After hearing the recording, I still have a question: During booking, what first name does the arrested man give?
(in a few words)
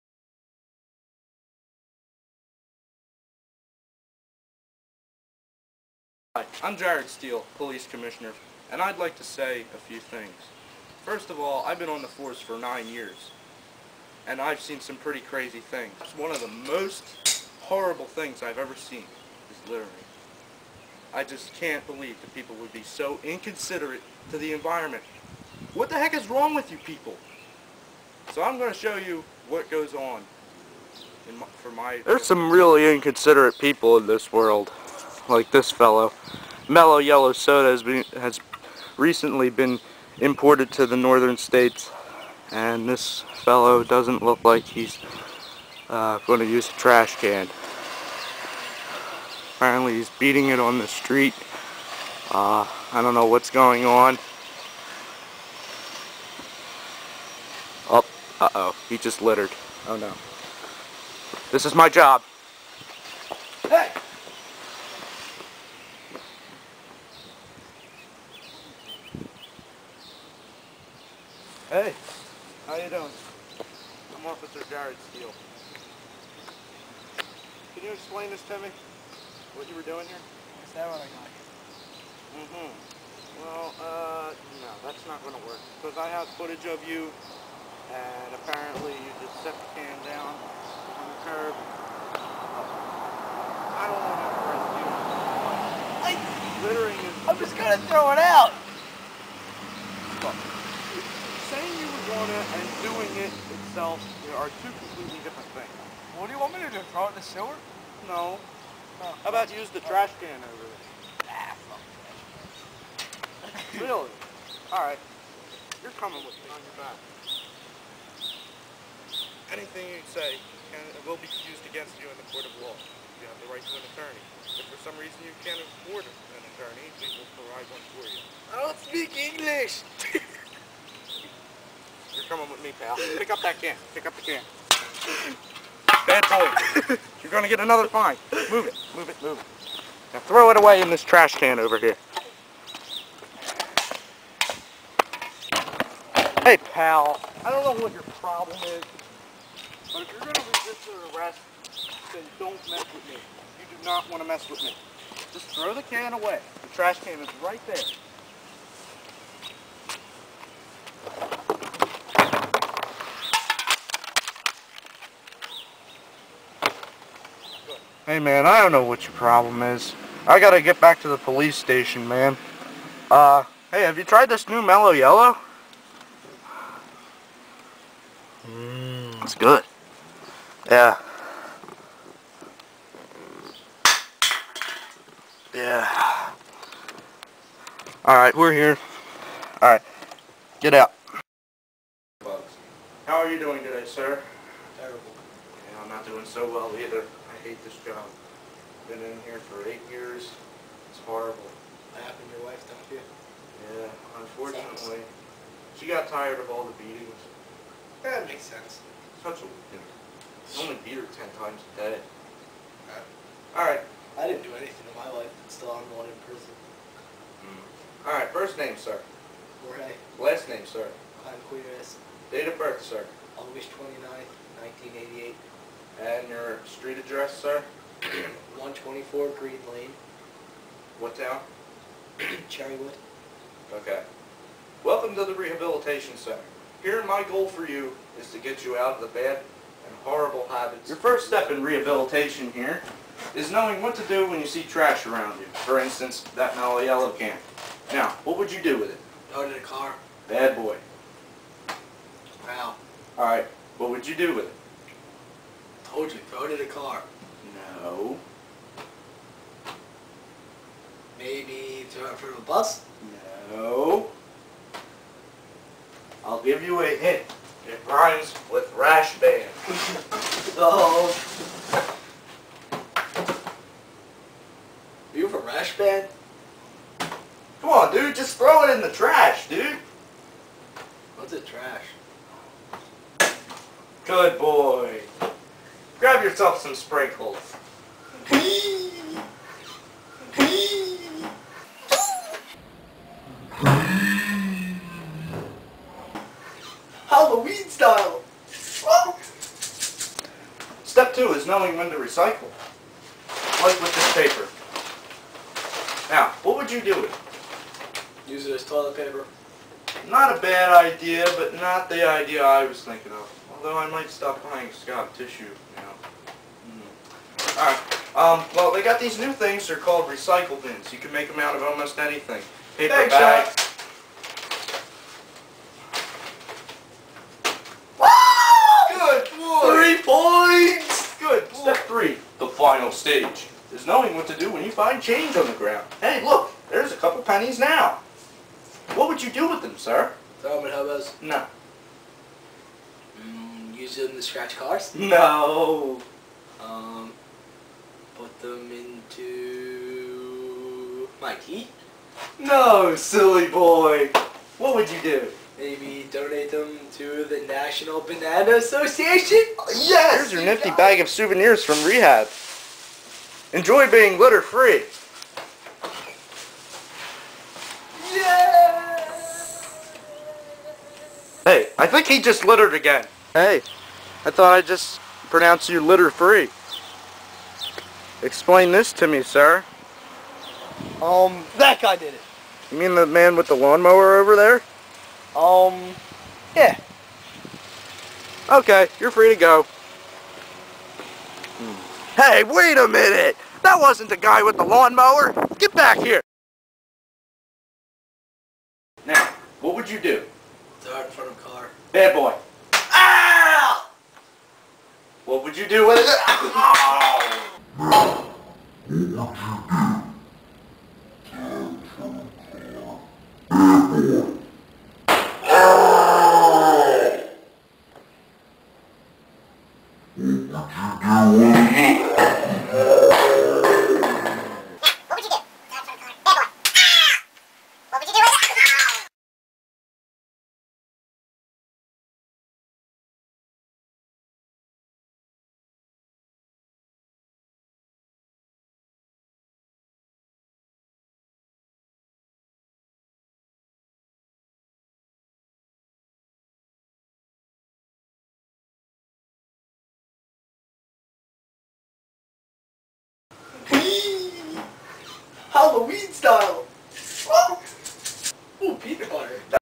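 Jorge.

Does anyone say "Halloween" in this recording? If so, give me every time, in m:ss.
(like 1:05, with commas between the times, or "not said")
4:57, 7:35.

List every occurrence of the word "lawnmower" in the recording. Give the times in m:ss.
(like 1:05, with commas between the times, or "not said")
6:23, 6:34.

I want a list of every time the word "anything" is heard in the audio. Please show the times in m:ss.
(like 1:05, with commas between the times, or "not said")
1:59, 3:34, 5:21.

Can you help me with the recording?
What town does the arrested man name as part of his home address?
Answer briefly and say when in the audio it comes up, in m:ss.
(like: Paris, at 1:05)
Cherrywood, at 3:52.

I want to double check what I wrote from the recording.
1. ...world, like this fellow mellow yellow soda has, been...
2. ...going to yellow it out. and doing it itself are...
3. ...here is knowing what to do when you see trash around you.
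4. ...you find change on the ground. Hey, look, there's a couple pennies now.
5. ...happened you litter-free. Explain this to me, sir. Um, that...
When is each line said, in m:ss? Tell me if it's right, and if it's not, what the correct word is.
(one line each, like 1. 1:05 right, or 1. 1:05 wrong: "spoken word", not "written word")
1. 0:34 right
2. 1:37 wrong: "throw", not "yellow"
3. 4:02 right
4. 5:34 right
5. 6:15 wrong: "pronounced", not "happened".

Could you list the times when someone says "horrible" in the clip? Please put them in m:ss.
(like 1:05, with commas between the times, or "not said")
0:17, 3:21, 4:00.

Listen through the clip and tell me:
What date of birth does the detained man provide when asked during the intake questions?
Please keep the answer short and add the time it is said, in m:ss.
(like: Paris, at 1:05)
August 29, 1988, at 3:43.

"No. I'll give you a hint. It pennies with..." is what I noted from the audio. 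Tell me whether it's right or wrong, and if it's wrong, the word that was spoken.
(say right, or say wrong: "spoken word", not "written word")
wrong: "rhymes", not "pennies".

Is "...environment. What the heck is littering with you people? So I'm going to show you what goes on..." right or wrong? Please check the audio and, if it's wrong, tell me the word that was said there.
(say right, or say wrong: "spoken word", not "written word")
wrong: "wrong", not "littering".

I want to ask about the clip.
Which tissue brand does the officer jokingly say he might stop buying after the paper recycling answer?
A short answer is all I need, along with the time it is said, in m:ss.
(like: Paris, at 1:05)
Scott, at 5:14.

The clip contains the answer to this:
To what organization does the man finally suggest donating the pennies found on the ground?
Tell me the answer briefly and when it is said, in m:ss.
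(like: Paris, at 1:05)
National Banana Association, at 5:57.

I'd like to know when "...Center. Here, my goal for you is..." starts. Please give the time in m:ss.
3:56.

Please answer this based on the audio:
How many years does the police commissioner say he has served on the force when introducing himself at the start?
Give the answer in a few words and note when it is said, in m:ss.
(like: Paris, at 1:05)
9, at 0:12.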